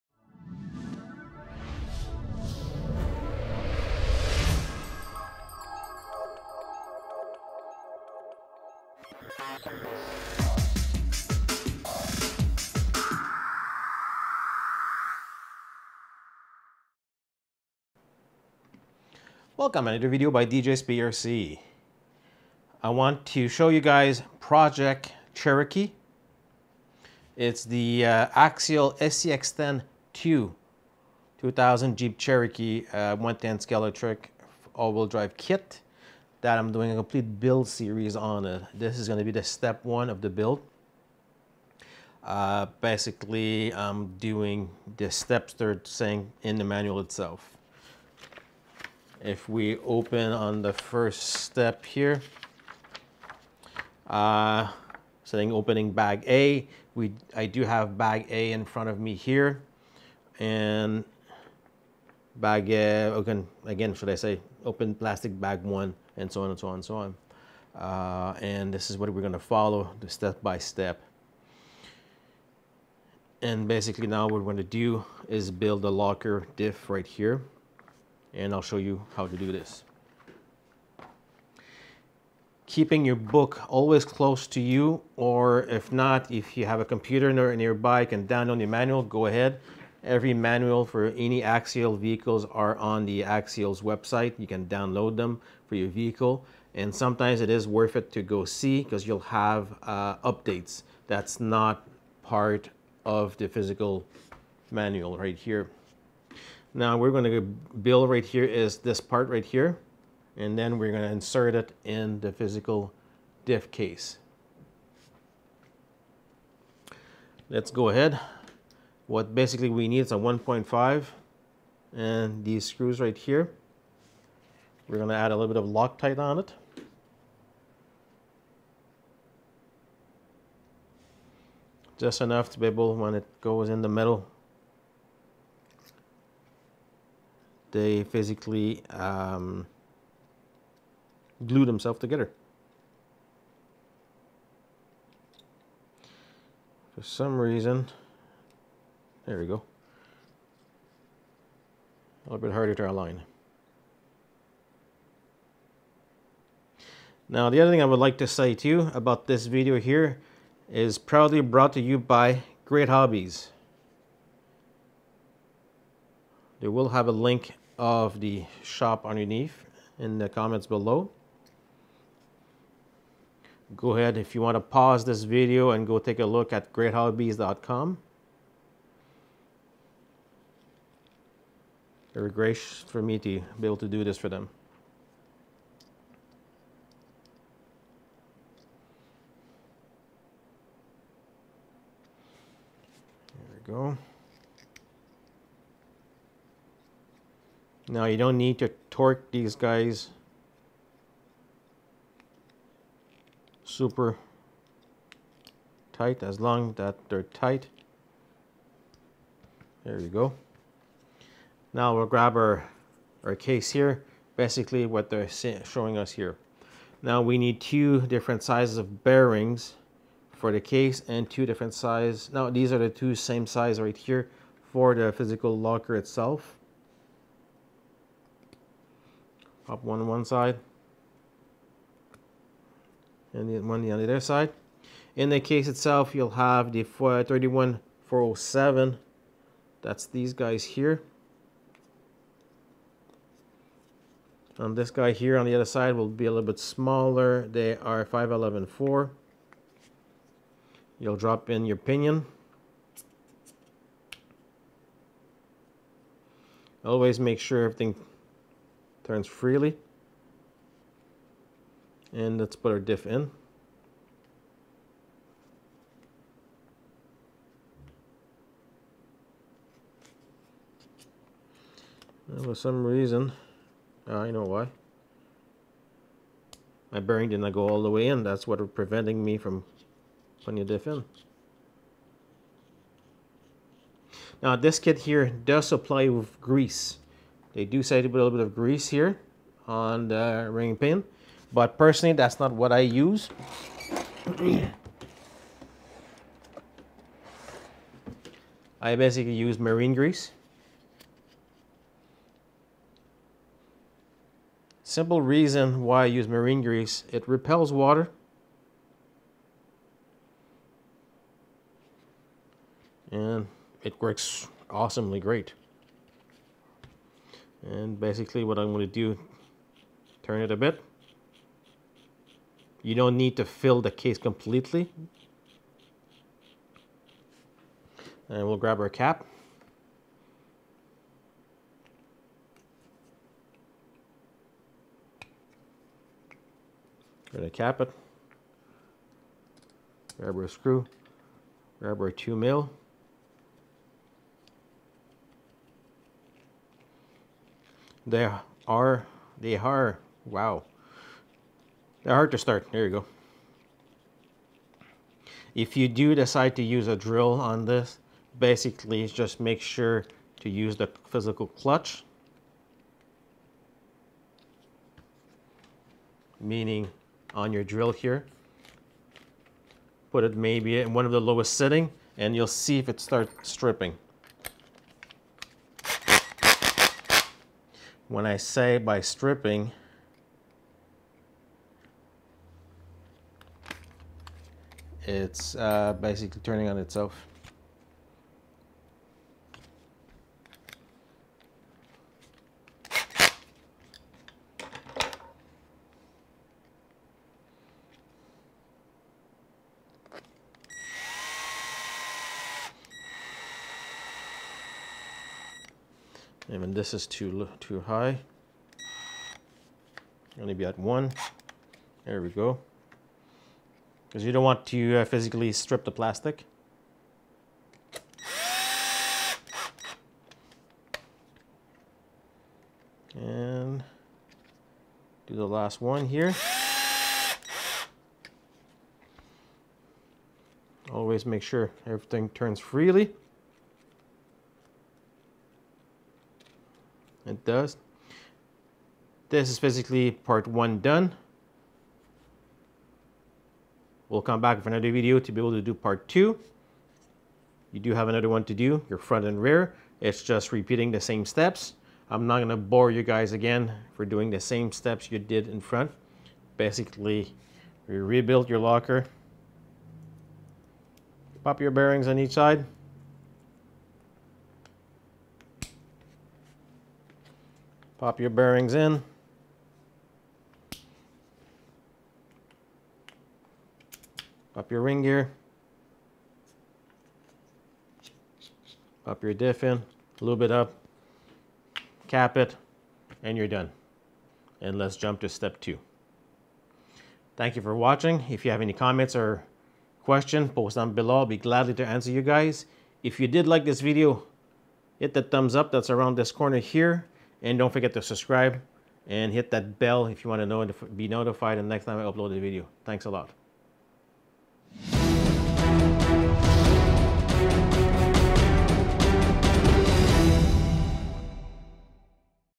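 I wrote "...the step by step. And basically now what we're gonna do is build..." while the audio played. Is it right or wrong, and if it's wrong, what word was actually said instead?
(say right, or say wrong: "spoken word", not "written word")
right.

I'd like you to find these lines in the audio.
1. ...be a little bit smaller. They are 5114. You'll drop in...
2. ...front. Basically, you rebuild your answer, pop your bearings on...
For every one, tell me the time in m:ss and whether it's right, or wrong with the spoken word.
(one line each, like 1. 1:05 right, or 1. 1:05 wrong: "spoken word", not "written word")
1. 4:06 right
2. 7:35 wrong: "locker", not "answer".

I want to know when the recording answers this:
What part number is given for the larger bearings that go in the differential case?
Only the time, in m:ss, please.
3:56.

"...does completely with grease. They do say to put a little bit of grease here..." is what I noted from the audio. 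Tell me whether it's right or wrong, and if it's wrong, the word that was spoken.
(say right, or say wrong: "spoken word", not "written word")
wrong: "supply", not "completely".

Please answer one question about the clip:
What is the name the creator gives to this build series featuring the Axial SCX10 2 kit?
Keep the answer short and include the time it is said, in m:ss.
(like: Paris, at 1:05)
Project Cherokee, at 0:24.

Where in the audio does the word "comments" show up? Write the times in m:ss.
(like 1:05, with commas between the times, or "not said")
2:50, 8:08.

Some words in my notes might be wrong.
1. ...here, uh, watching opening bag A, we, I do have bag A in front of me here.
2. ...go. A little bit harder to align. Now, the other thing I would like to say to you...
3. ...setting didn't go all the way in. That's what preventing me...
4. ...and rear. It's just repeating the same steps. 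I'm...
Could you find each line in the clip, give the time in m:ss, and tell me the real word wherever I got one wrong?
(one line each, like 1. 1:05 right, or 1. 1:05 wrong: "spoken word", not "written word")
1. 0:51 wrong: "saying", not "watching"
2. 2:29 right
3. 4:36 wrong: "bearing", not "setting"
4. 7:29 right.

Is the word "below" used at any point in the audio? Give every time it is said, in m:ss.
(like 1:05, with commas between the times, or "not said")
2:50, 8:10.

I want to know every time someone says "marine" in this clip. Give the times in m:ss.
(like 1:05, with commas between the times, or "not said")
4:59, 5:06.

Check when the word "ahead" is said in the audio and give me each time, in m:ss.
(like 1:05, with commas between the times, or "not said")
1:29, 1:57, 2:53.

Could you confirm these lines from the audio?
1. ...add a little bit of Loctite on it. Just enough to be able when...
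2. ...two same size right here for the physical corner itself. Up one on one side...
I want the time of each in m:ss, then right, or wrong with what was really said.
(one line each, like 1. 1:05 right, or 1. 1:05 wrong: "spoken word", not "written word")
1. 2:05 right
2. 3:42 wrong: "locker", not "corner".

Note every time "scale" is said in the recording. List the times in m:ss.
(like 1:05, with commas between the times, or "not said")
0:33.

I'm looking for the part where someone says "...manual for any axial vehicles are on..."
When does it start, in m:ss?
1:30.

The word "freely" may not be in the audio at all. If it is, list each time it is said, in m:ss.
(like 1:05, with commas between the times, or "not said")
4:19, 7:12.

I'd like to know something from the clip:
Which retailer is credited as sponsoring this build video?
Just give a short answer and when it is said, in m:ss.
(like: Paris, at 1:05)
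Great Hobbies, at 2:42.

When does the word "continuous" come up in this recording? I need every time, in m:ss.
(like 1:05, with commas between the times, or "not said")
not said.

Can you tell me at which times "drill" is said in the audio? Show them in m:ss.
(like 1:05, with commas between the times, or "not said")
5:56, 6:07.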